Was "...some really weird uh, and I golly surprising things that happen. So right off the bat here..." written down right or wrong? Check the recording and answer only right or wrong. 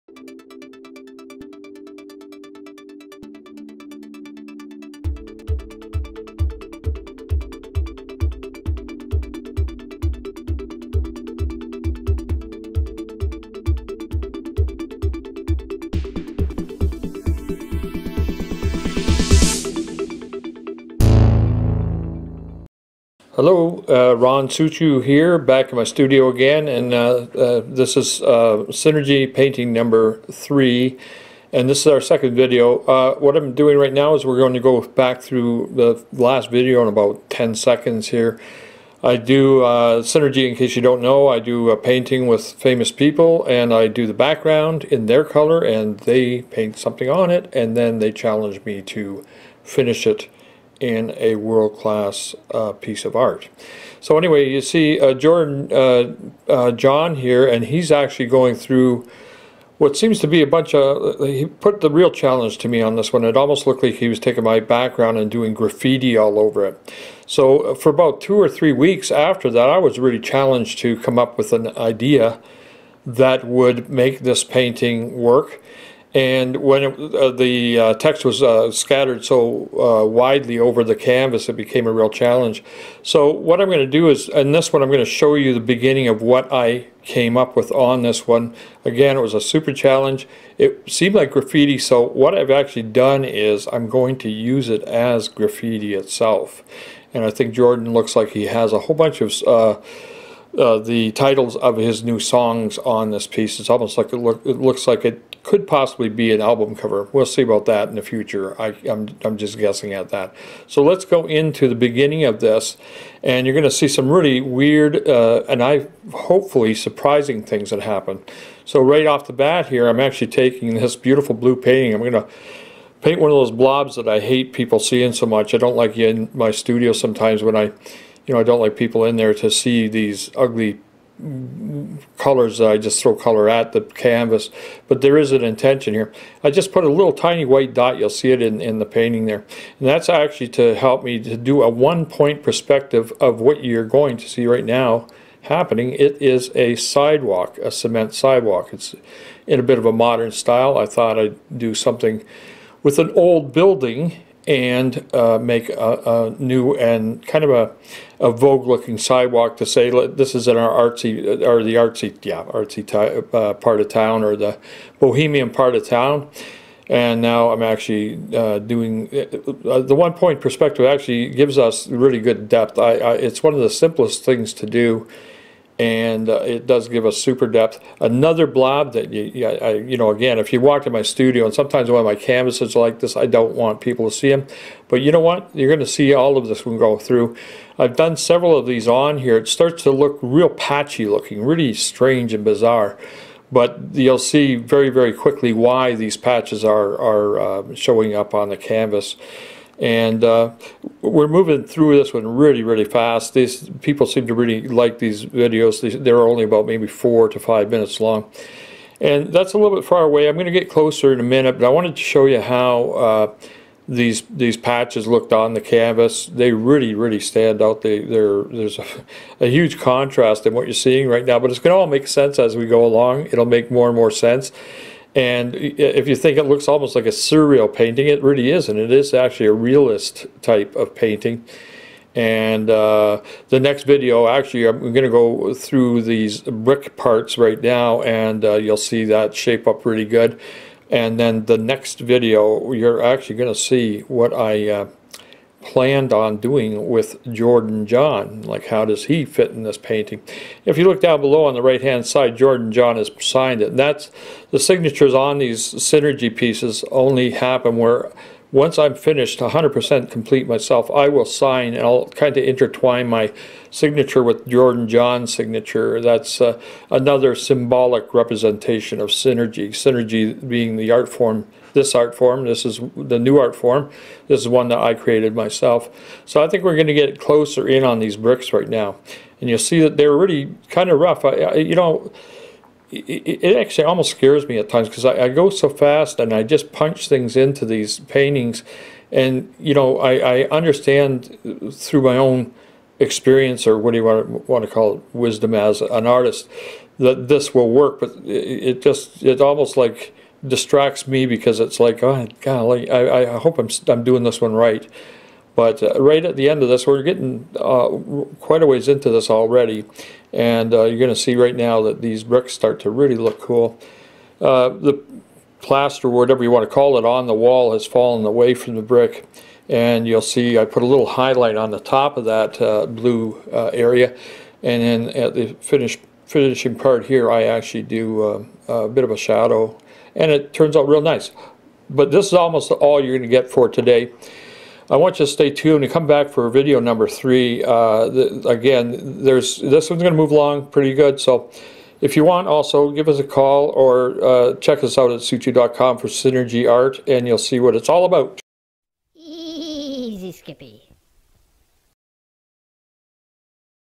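wrong.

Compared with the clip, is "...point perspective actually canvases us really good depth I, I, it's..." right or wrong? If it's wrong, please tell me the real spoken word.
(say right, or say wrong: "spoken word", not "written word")
wrong: "gives", not "canvases".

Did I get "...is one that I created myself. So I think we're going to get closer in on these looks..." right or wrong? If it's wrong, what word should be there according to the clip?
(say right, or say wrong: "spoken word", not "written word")
wrong: "bricks", not "looks".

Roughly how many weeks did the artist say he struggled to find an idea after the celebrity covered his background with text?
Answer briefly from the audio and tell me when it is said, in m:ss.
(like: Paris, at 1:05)
2 or 3 weeks, at 1:08.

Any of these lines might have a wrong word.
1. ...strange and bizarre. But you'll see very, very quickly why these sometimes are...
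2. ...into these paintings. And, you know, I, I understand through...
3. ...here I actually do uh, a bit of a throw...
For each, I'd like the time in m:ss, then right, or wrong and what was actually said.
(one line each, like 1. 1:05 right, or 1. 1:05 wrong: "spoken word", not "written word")
1. 3:11 wrong: "patches", not "sometimes"
2. 4:47 right
3. 5:27 wrong: "shadow", not "throw".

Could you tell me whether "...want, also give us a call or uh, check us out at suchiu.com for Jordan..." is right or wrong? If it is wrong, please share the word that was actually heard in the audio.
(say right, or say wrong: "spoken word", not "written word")
wrong: "Synergy", not "Jordan".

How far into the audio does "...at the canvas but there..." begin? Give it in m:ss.
2:13.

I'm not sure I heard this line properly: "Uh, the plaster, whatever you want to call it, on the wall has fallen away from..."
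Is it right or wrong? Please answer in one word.
right.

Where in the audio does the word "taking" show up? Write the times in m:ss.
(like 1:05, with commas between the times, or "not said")
1:04, 2:00.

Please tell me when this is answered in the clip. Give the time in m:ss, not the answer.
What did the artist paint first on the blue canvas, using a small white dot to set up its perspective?
2:27.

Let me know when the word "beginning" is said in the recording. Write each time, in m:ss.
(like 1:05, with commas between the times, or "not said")
1:25, 1:51.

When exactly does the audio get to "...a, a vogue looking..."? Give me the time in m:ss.
2:37.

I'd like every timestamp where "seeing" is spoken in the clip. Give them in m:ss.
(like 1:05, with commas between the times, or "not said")
2:04, 3:40.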